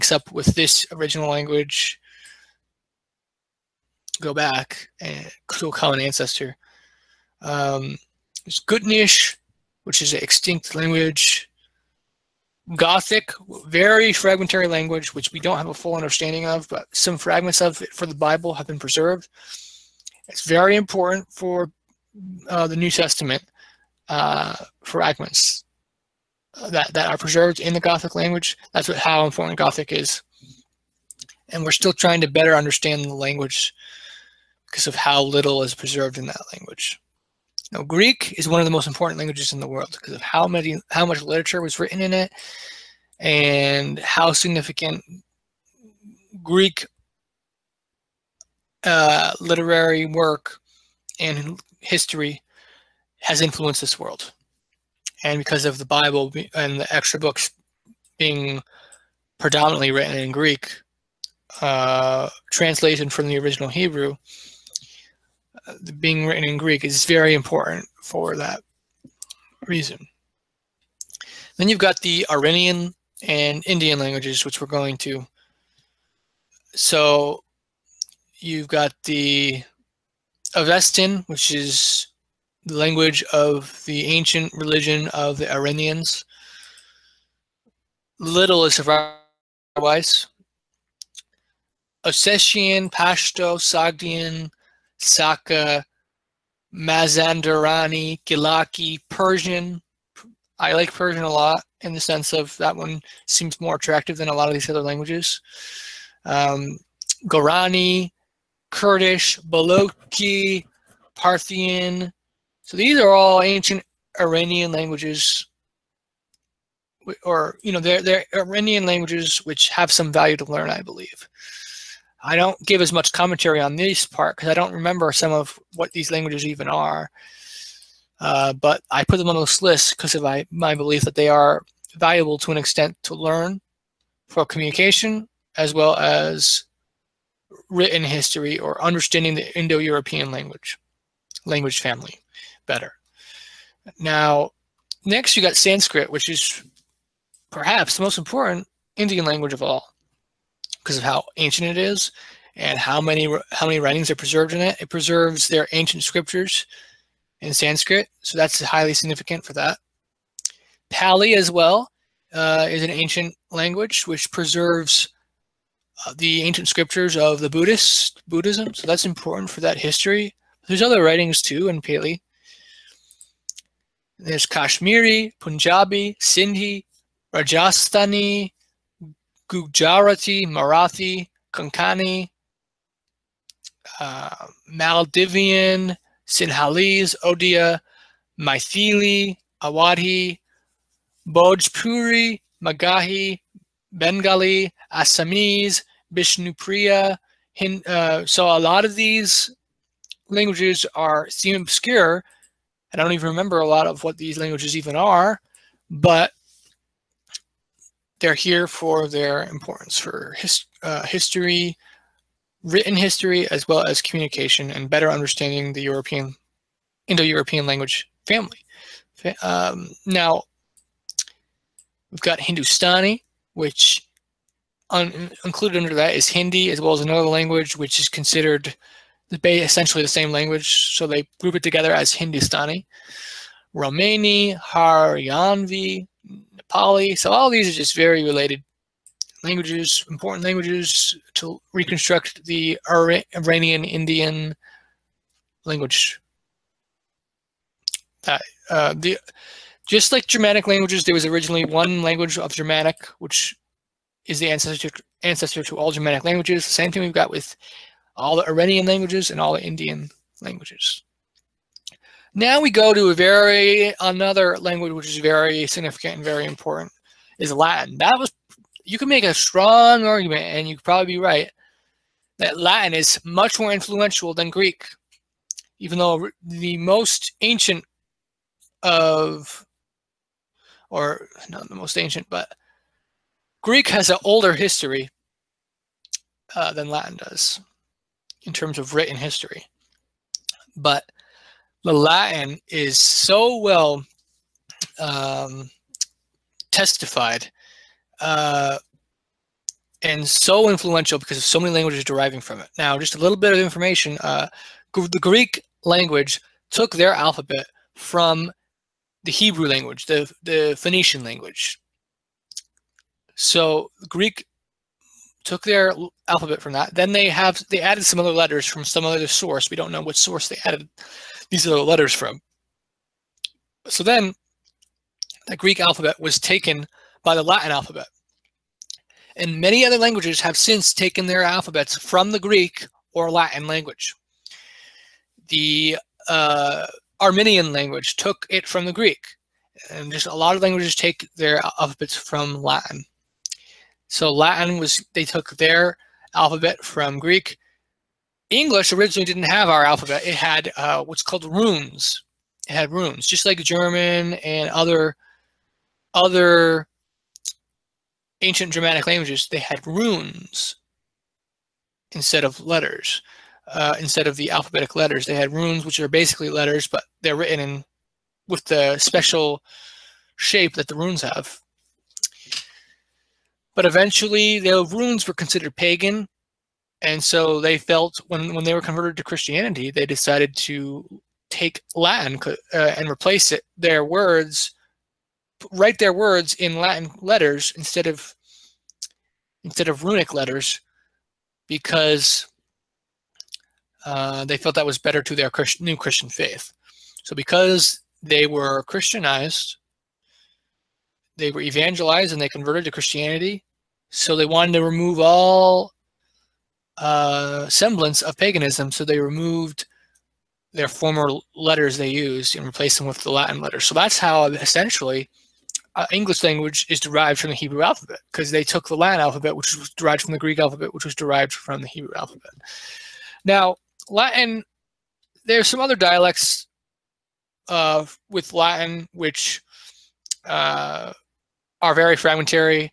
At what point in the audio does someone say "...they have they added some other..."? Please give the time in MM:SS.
05:17.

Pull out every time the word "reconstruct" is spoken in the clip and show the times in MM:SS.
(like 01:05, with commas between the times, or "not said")
04:01.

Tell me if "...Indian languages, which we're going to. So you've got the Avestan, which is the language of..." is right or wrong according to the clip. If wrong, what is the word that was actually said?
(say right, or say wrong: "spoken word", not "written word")
right.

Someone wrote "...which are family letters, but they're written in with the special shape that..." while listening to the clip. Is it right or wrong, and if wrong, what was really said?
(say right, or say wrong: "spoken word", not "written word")
wrong: "basically", not "family".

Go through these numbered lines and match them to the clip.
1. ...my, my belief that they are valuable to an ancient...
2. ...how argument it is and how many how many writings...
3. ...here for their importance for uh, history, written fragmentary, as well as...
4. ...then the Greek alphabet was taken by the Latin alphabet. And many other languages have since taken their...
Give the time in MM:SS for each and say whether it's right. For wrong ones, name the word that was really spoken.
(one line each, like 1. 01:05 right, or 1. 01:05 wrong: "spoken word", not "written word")
1. 02:10 wrong: "extent", not "ancient"
2. 02:31 wrong: "ancient", not "argument"
3. 03:28 wrong: "history", not "fragmentary"
4. 05:24 right.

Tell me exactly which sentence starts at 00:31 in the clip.
And we're still trying to better understand the language because of how little is preserved in that language.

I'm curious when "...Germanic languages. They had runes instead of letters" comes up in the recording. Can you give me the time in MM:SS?
05:58.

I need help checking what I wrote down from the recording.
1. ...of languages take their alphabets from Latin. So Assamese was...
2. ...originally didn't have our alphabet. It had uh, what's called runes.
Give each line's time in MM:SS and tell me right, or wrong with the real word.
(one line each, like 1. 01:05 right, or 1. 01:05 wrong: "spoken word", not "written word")
1. 05:40 wrong: "Latin", not "Assamese"
2. 05:48 right.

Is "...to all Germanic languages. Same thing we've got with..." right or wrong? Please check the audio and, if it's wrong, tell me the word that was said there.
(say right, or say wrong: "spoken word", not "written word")
right.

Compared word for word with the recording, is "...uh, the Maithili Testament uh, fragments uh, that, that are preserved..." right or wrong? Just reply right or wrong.
wrong.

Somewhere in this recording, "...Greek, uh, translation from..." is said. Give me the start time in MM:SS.
01:00.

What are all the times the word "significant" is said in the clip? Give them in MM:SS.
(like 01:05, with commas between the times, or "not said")
00:44, 02:38, 04:25.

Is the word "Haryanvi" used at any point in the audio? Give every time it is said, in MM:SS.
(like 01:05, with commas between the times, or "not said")
03:54.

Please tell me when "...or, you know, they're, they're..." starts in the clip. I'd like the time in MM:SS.
01:57.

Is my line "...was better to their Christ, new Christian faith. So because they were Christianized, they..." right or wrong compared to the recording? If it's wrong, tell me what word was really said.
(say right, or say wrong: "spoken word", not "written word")
right.